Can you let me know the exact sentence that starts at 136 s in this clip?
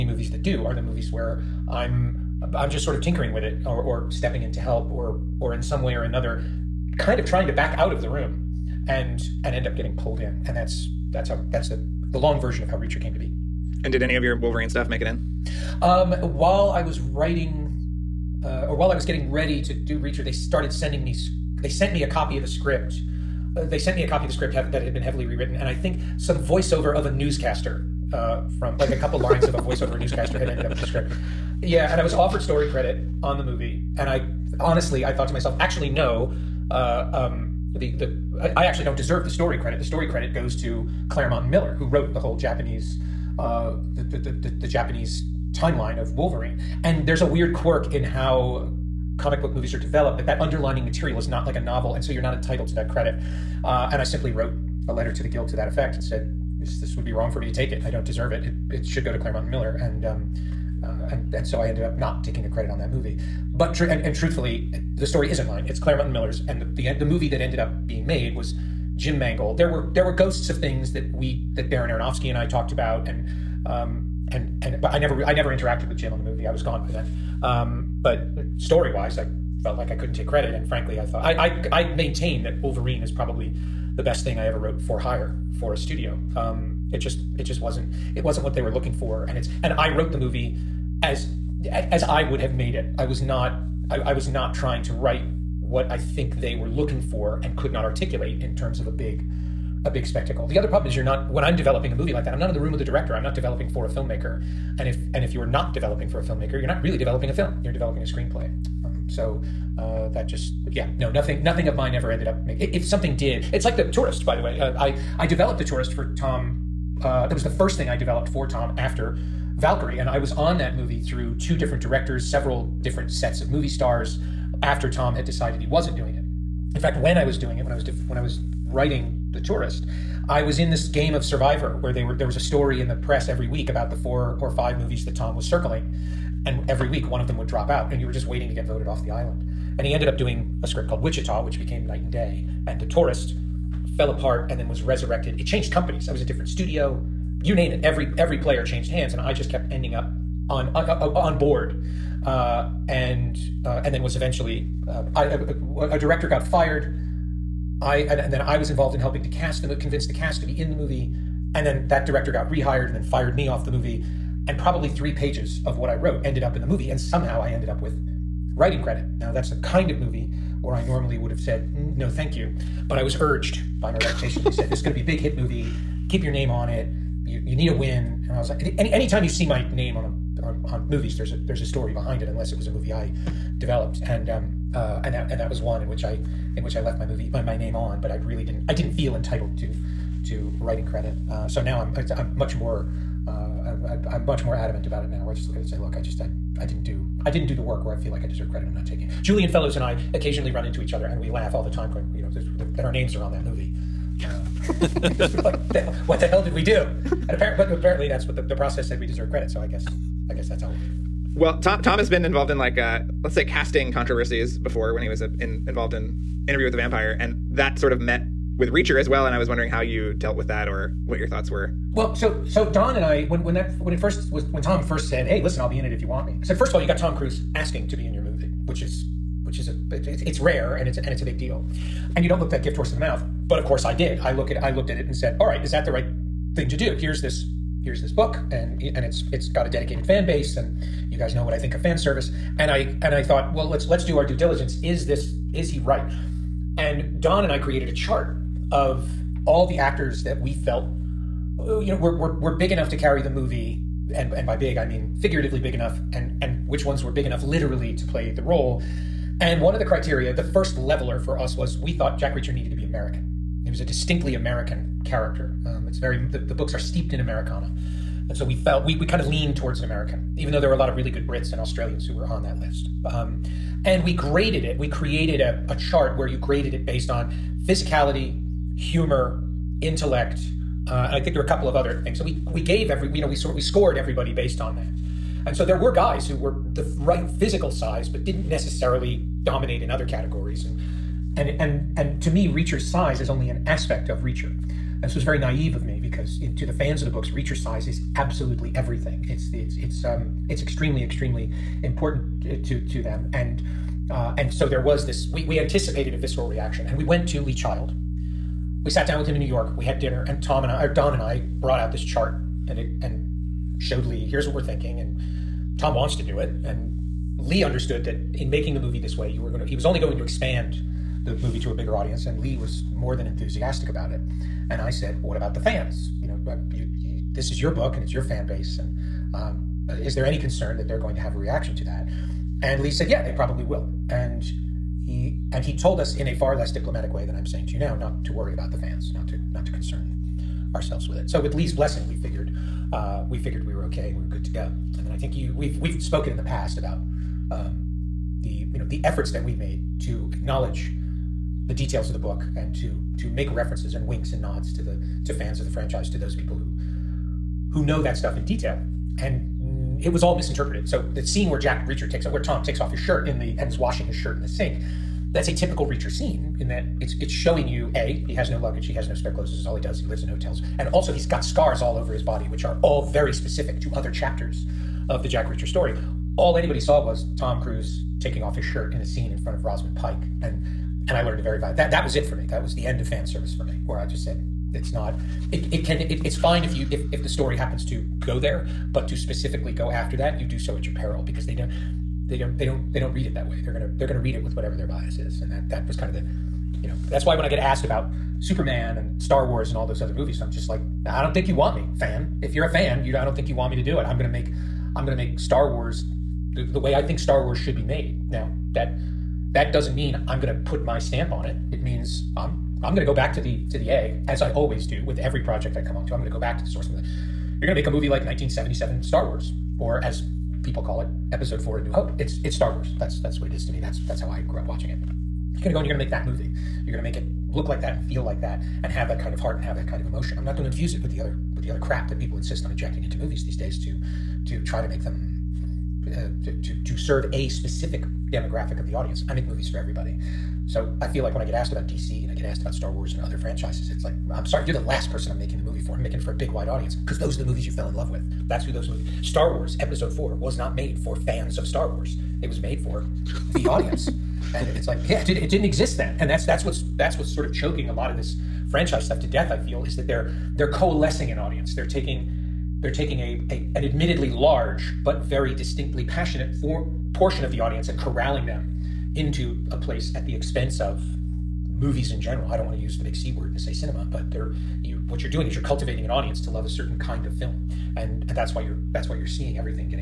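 And every week one of them would drop out and you were just waiting to get voted off the island.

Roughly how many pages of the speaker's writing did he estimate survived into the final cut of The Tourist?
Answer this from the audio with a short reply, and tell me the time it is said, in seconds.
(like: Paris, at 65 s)
3, at 164 s.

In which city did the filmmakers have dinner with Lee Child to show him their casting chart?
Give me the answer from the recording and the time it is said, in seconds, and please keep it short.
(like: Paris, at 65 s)
New York, at 309 s.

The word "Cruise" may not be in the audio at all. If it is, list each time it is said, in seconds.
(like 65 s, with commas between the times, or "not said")
227 s, 377 s.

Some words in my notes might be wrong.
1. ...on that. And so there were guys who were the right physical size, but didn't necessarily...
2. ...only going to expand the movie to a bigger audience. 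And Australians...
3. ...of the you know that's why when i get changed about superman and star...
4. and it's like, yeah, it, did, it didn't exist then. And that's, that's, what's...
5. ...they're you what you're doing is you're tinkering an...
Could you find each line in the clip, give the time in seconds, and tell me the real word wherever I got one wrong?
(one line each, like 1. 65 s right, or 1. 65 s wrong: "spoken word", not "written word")
1. 284 s right
2. 319 s wrong: "Lee", not "Australians"
3. 396 s wrong: "asked", not "changed"
4. 454 s right
5. 474 s wrong: "cultivating", not "tinkering".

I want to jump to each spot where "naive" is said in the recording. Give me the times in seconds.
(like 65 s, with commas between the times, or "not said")
295 s.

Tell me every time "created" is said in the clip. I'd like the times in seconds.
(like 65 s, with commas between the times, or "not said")
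247 s, 274 s.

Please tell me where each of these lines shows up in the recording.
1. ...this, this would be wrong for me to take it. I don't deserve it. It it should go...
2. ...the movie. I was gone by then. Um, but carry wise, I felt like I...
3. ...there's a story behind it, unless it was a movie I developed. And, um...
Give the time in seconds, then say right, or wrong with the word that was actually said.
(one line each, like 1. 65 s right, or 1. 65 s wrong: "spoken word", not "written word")
1. 56 s right
2. 76 s wrong: "story", not "carry"
3. 181 s right.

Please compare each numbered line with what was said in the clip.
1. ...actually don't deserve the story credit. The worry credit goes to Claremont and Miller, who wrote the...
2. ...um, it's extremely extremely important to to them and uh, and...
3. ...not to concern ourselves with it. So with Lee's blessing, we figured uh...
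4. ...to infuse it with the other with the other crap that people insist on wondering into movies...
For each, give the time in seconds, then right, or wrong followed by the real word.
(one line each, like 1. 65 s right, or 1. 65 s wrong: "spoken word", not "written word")
1. 38 s wrong: "story", not "worry"
2. 300 s right
3. 339 s right
4. 430 s wrong: "injecting", not "wondering".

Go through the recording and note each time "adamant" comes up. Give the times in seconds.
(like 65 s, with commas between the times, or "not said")
194 s.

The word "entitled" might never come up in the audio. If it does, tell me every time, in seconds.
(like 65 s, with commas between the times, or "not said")
52 s, 189 s.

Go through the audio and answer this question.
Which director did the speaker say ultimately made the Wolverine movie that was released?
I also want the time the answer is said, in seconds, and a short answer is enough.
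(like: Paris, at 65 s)
Jim Mangold, at 68 s.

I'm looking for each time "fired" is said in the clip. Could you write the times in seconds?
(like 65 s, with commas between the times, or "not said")
156 s, 163 s.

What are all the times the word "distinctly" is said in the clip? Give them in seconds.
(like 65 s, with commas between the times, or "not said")
263 s, 465 s.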